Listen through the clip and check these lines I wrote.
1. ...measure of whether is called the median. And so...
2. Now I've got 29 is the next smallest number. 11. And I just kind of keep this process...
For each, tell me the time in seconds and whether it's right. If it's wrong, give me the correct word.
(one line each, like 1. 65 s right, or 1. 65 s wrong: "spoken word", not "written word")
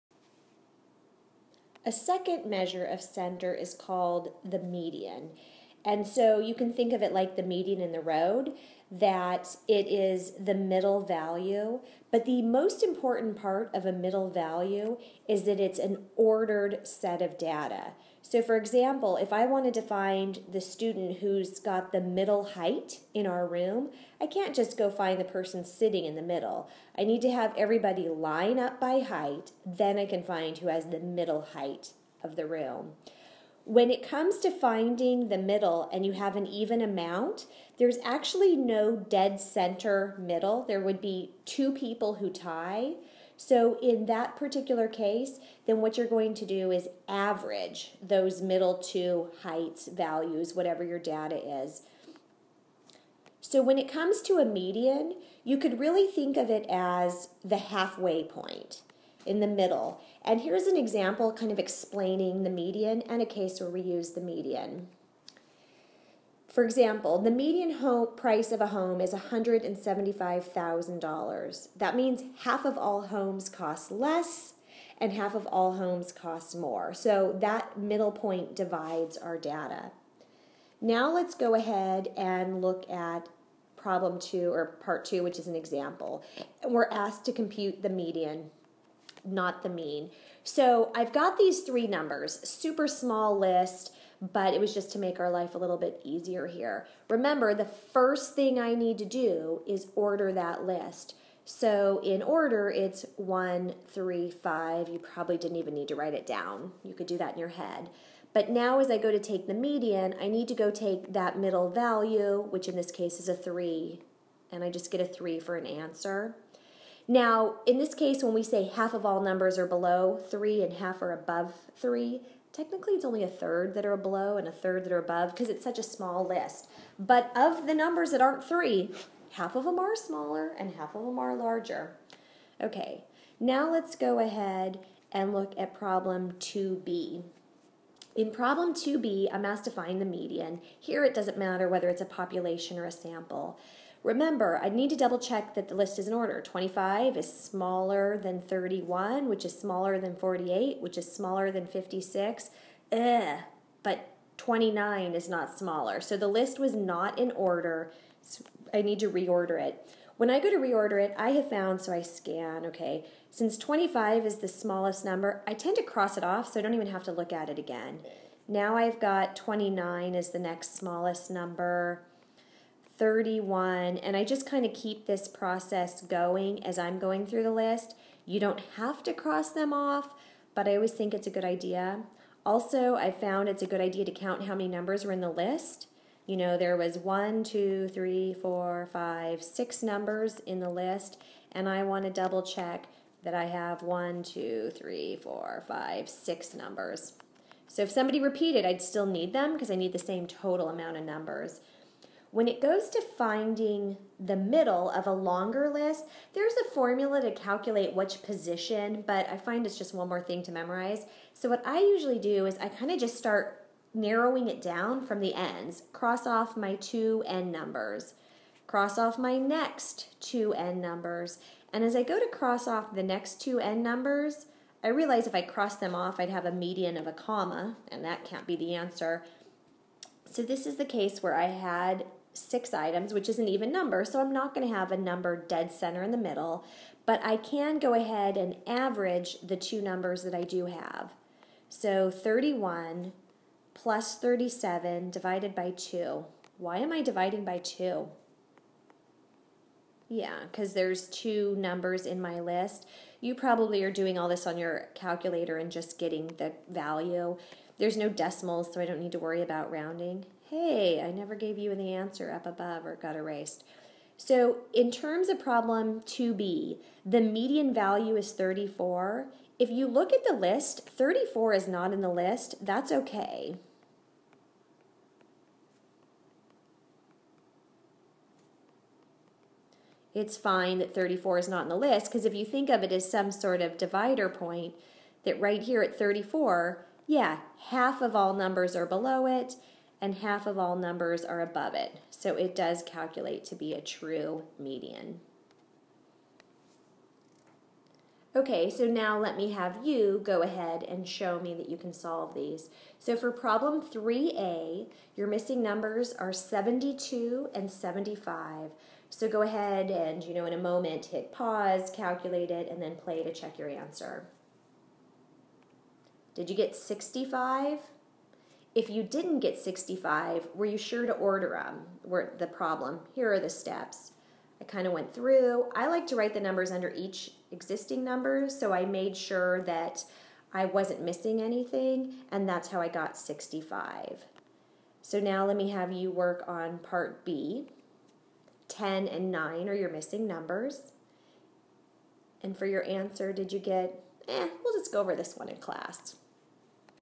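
1. 2 s wrong: "center", not "whether"
2. 168 s wrong: "31", not "11".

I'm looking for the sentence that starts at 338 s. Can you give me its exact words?
10 and 9 are your missing numbers.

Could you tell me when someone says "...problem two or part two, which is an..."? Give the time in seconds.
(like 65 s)
83 s.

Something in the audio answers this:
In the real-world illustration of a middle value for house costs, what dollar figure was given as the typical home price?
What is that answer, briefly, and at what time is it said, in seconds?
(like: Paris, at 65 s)
$175,000, at 69 s.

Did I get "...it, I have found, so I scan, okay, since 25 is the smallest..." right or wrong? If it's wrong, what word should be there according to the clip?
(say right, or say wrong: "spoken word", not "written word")
right.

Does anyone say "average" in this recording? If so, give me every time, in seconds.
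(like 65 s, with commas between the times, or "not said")
47 s, 238 s.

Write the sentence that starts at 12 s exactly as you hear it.
But the most important part of a middle value is that it's an ordered set of data.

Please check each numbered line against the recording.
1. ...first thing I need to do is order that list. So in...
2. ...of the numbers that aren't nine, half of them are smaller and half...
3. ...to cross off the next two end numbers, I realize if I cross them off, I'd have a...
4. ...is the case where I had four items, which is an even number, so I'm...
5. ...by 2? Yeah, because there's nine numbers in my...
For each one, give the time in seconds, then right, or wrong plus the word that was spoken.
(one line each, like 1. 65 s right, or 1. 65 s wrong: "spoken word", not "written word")
1. 97 s right
2. 127 s wrong: "three", not "nine"
3. 222 s right
4. 230 s wrong: "six", not "four"
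5. 247 s wrong: "two", not "nine".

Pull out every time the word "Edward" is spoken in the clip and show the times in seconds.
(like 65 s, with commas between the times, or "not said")
not said.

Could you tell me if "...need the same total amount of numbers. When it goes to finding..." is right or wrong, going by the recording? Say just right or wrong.
right.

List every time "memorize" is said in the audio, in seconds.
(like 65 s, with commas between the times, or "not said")
210 s.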